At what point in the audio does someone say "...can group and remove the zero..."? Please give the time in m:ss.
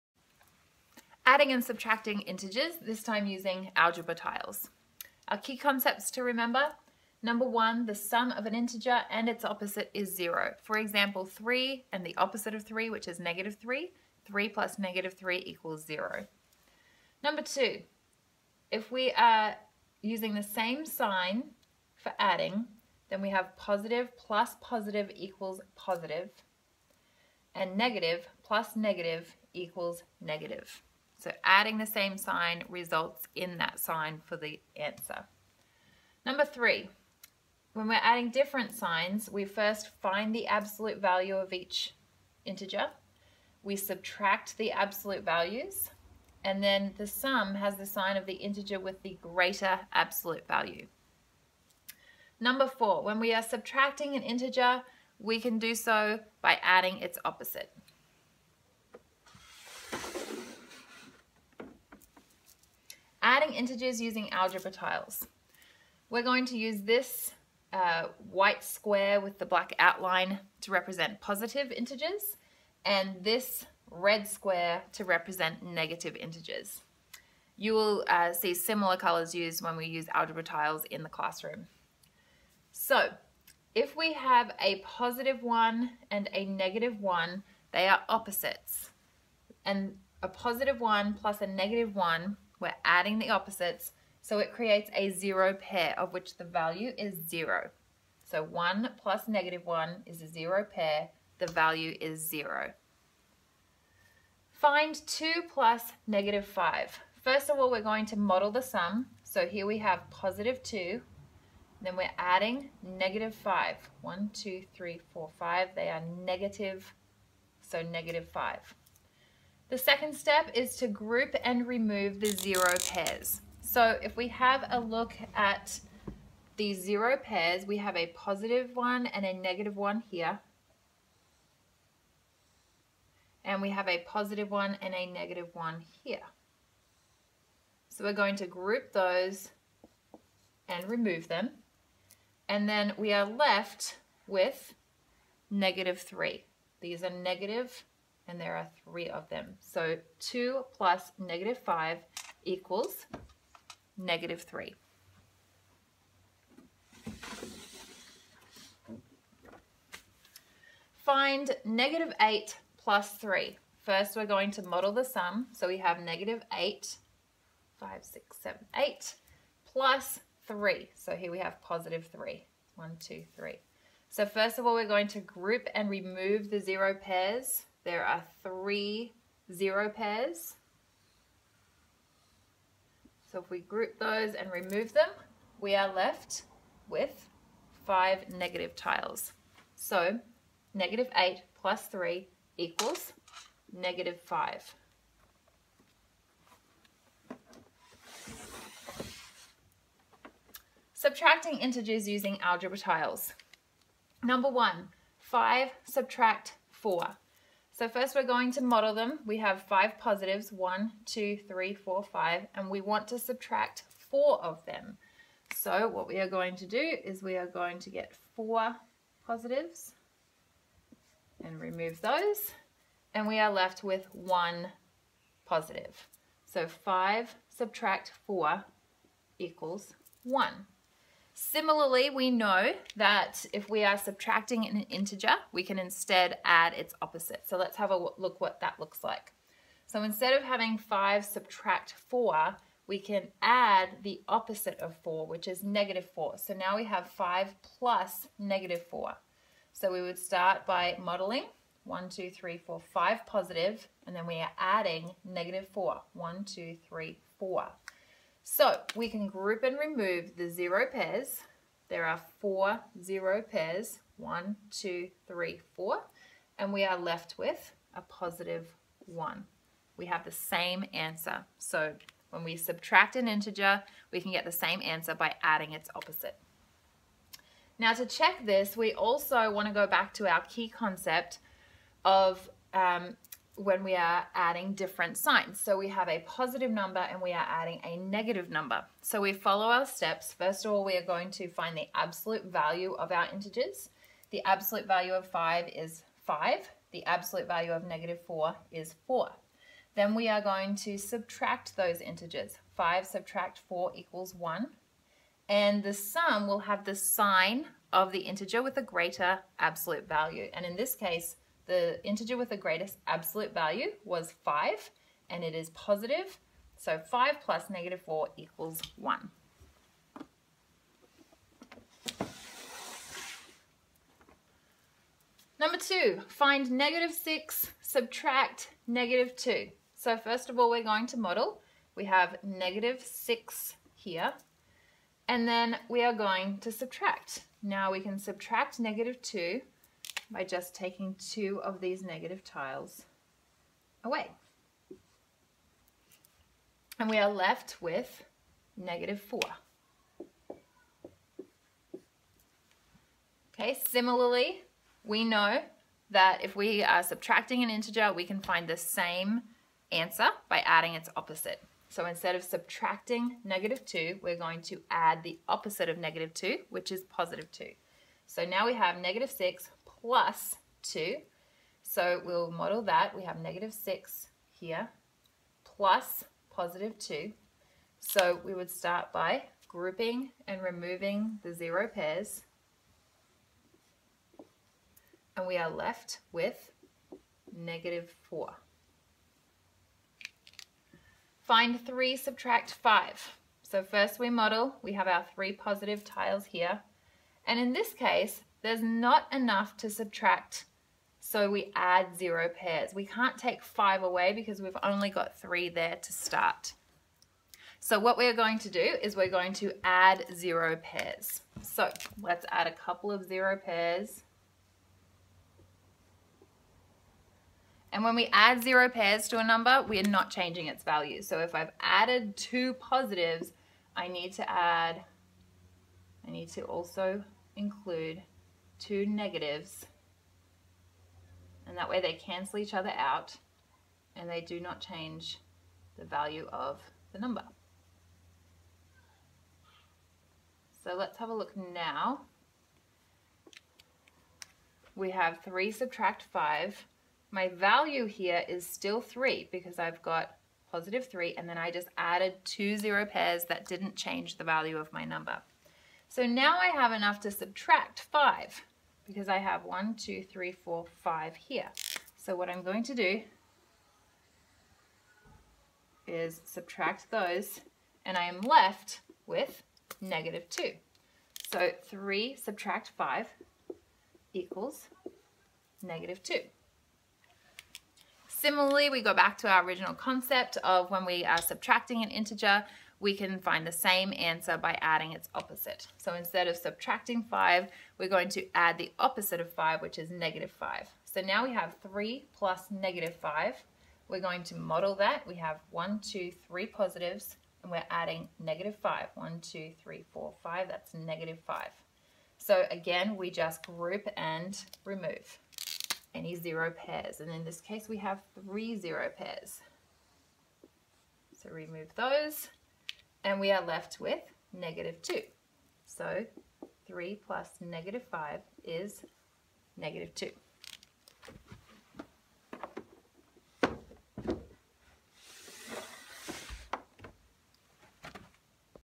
4:19.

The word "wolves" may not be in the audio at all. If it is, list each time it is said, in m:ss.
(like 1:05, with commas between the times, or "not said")
not said.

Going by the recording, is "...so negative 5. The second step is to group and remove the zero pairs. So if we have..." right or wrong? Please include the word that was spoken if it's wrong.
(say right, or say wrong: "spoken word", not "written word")
right.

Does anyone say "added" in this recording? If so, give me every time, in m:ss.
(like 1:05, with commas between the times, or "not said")
7:01, 7:31.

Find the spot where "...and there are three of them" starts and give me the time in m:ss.
2:28.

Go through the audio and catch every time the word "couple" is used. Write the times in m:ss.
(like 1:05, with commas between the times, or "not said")
6:52.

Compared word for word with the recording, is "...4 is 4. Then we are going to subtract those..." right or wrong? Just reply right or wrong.
right.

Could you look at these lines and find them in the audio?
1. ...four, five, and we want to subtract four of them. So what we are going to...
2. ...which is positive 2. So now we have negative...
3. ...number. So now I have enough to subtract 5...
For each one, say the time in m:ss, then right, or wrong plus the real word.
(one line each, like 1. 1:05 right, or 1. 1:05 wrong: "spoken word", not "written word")
1. 3:31 right
2. 6:06 right
3. 7:35 right.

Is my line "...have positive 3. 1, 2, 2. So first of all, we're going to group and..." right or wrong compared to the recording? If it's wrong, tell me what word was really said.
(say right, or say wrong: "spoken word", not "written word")
wrong: "3", not "2".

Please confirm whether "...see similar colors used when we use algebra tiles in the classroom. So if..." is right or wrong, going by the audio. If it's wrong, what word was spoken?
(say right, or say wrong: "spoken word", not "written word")
right.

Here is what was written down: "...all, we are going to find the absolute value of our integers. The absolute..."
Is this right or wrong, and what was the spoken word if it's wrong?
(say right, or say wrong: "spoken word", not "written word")
right.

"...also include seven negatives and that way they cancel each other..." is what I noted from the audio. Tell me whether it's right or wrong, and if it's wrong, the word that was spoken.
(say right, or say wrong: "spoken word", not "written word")
wrong: "two", not "seven".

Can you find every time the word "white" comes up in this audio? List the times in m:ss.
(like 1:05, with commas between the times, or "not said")
1:08.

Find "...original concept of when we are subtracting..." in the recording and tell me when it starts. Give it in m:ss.
7:59.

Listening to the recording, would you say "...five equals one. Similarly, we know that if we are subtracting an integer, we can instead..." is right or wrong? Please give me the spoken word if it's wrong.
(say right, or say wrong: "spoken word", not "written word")
wrong: "four", not "five".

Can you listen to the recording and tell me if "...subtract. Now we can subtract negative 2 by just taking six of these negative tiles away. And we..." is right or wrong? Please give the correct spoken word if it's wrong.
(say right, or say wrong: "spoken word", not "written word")
wrong: "two", not "six".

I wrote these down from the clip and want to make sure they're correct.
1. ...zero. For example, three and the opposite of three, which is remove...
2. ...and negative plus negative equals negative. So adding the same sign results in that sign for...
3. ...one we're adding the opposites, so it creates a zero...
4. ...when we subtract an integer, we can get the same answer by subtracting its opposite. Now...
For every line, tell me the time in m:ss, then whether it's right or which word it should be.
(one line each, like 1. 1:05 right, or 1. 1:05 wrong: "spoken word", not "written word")
1. 0:10 wrong: "negative", not "remove"
2. 0:27 right
3. 1:31 right
4. 4:32 wrong: "adding", not "subtracting".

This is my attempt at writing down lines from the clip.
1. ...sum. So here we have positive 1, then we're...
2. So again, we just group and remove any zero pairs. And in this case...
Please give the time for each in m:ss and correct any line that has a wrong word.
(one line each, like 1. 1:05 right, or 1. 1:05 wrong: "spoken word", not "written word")
1. 1:48 wrong: "2", not "1"
2. 8:22 right.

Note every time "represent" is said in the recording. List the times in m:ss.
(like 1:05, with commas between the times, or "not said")
1:10, 1:15.